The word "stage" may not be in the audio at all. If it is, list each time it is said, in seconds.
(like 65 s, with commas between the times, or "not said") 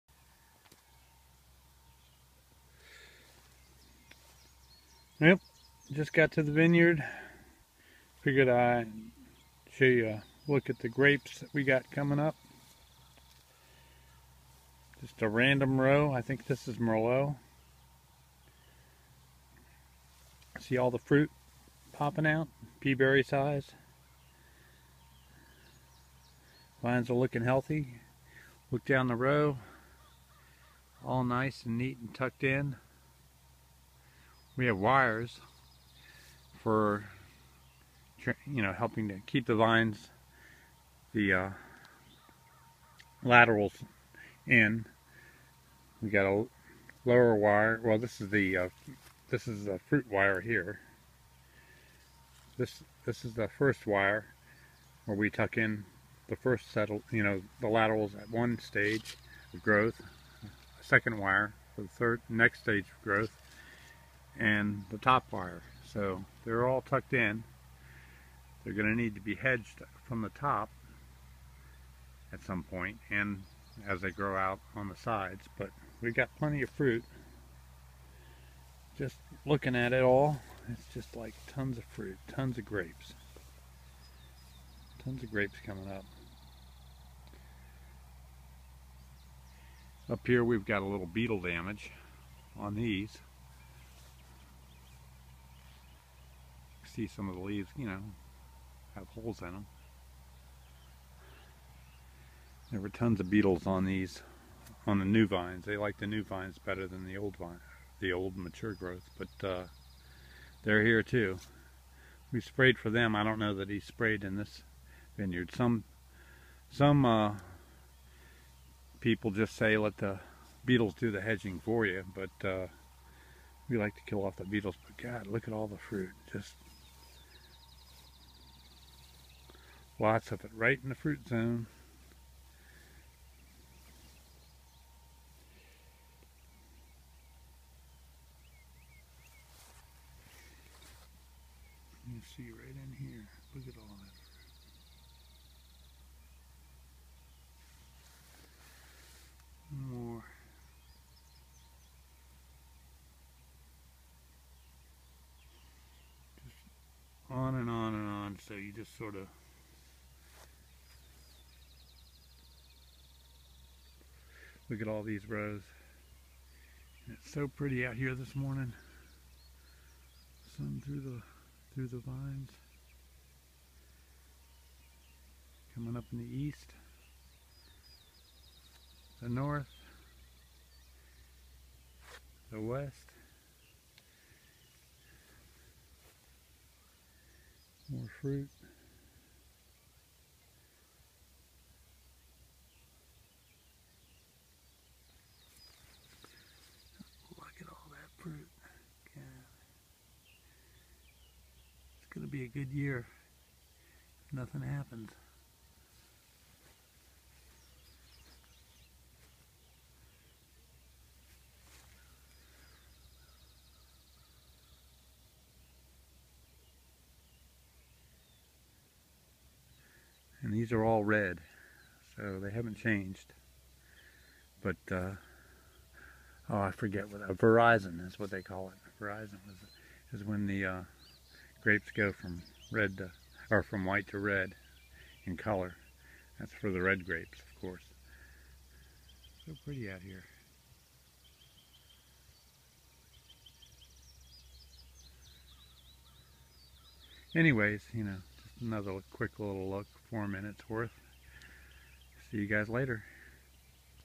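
58 s, 62 s.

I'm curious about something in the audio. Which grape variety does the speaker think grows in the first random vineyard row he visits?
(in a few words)
Merlot.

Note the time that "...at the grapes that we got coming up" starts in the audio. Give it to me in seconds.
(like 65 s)
10 s.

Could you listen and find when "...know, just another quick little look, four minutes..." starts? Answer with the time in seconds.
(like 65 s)
248 s.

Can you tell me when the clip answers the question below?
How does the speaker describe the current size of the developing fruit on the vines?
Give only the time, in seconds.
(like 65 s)
22 s.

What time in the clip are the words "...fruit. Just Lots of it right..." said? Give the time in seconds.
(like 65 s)
125 s.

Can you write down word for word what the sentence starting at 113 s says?
I don't know that he sprayed in this vineyard.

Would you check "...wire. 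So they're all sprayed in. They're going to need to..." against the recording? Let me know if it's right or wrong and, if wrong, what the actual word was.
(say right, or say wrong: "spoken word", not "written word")
wrong: "tucked", not "sprayed".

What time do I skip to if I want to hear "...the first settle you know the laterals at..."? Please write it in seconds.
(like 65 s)
56 s.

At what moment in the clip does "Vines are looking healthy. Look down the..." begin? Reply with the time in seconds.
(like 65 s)
26 s.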